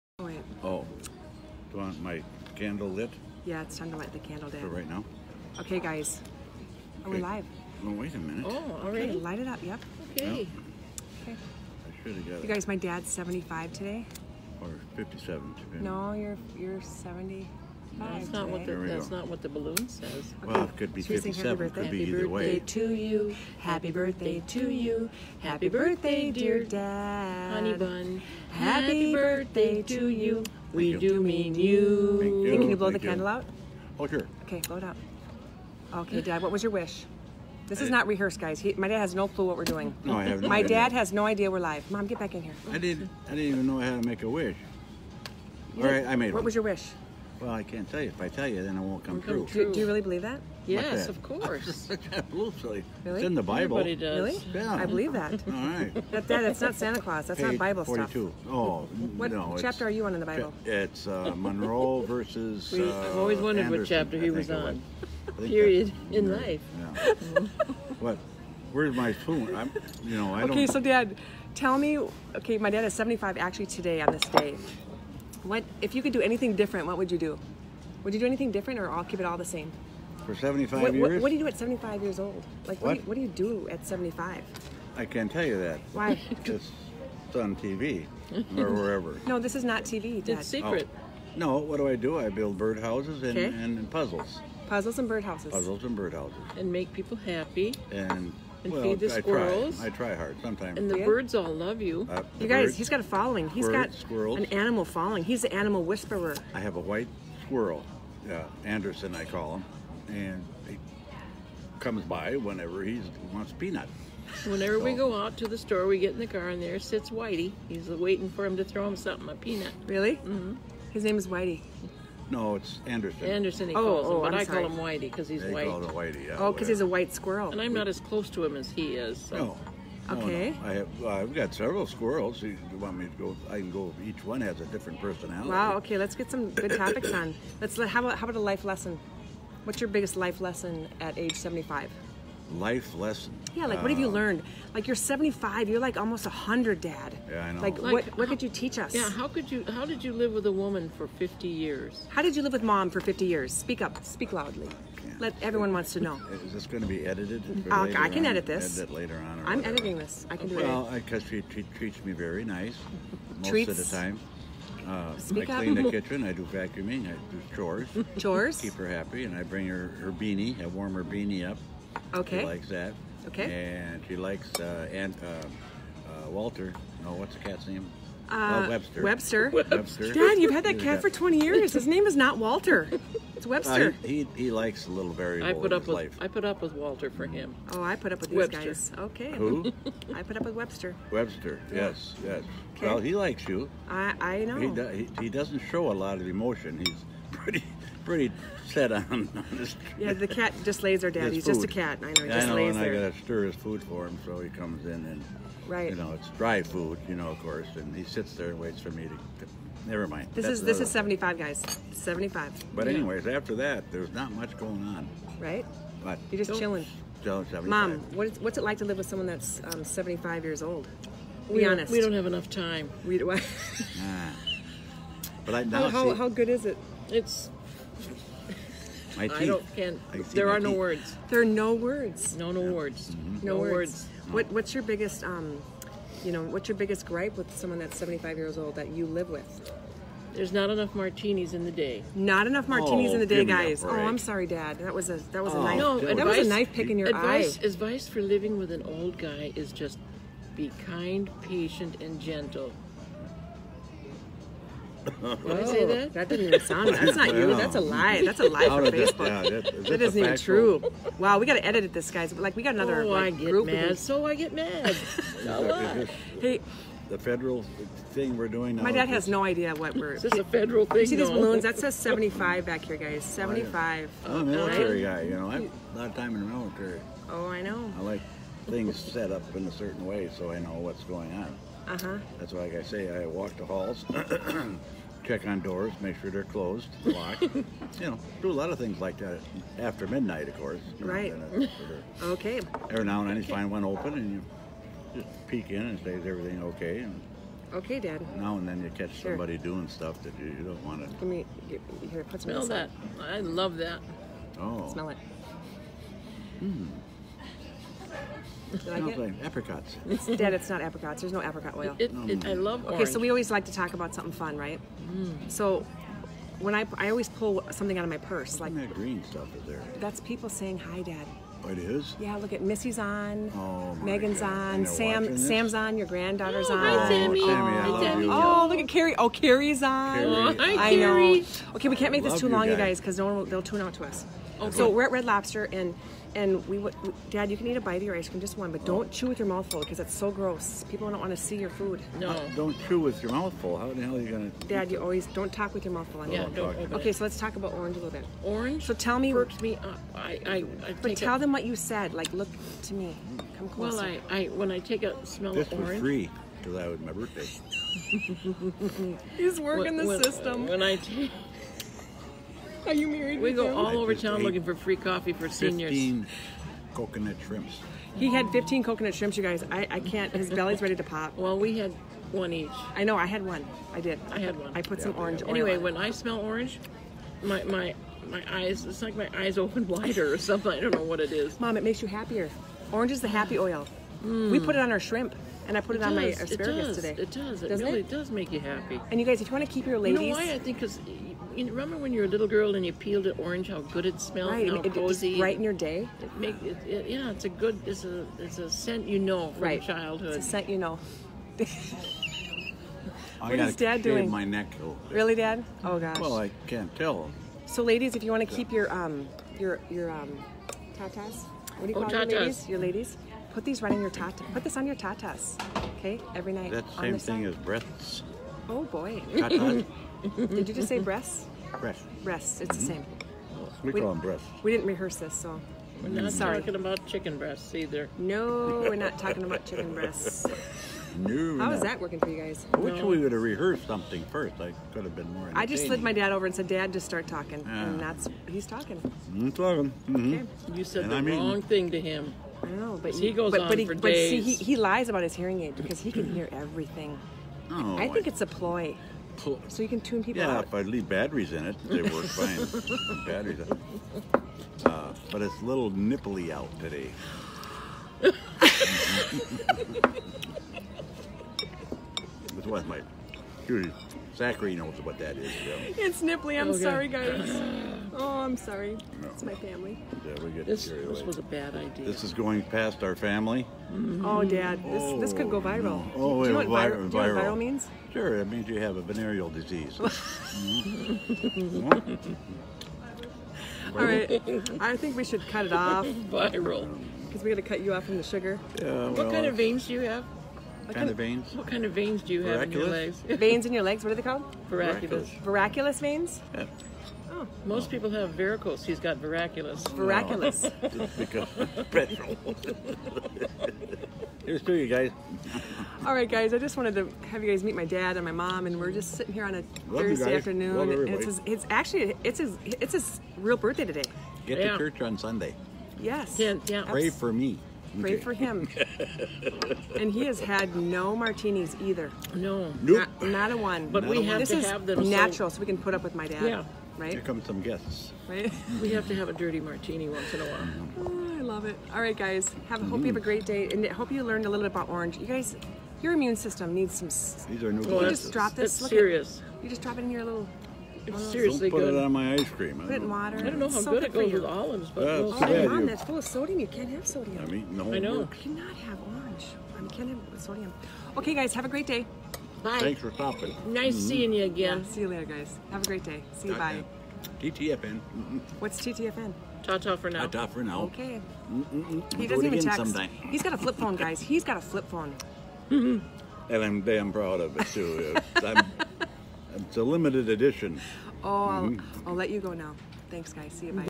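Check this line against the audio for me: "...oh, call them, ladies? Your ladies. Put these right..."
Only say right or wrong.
right.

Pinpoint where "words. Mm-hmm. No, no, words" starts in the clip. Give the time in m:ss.
3:52.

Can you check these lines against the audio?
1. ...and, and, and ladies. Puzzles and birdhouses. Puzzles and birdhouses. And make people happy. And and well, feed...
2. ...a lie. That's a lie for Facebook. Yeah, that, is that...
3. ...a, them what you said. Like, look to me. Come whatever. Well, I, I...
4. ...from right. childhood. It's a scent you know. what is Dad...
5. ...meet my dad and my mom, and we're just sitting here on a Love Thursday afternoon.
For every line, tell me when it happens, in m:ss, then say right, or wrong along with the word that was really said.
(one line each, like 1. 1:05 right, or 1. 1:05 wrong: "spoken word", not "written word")
1. 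1:33 wrong: "puzzles", not "ladies"
2. 4:17 right
3. 5:51 wrong: "closer", not "whatever"
4. 6:39 right
5. 8:27 right.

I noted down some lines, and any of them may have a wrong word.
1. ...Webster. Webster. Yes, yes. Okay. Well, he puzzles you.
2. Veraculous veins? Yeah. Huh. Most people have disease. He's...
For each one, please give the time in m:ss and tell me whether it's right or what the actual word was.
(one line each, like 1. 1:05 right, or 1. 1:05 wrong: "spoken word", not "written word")
1. 3:10 wrong: "likes", not "puzzles"
2. 8:15 wrong: "varicose", not "disease".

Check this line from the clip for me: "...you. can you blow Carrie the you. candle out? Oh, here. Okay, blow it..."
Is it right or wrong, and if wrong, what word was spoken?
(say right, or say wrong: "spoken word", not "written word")
wrong: "Thank", not "Carrie".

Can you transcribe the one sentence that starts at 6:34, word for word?
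how cozy, right in your day.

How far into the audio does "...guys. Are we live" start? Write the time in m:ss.
0:05.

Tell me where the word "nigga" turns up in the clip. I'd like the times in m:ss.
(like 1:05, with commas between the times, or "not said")
not said.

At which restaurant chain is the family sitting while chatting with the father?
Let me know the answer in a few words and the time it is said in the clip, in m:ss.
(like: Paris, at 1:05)
Red Lobster, at 5:35.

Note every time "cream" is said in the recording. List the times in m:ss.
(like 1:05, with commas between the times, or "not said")
5:38, 9:02.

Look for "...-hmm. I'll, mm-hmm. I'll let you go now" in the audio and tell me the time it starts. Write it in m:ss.
9:31.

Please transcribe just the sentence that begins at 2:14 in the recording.
Each one has a different personality.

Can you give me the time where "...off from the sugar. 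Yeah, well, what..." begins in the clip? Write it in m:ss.
8:07.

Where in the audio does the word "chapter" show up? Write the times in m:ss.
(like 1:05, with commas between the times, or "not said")
0:59, 1:03.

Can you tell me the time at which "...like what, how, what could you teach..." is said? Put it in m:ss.
2:27.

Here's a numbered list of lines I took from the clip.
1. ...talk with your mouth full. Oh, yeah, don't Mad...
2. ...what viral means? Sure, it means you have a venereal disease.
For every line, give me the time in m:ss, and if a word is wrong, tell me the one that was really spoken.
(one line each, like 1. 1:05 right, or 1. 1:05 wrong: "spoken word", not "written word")
1. 5:45 wrong: "Okay", not "Mad"
2. 7:57 right.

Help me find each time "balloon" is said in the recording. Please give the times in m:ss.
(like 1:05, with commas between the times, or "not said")
0:19, 4:31.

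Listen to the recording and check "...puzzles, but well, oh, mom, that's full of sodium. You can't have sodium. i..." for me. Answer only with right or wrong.
wrong.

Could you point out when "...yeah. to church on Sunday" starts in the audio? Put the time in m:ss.
8:34.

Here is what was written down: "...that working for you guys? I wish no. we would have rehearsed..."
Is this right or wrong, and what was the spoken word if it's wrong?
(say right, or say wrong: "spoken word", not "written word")
right.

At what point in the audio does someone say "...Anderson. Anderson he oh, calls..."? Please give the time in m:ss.
2:02.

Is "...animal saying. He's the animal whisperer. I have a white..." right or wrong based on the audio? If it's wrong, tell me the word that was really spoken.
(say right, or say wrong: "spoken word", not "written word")
wrong: "following", not "saying".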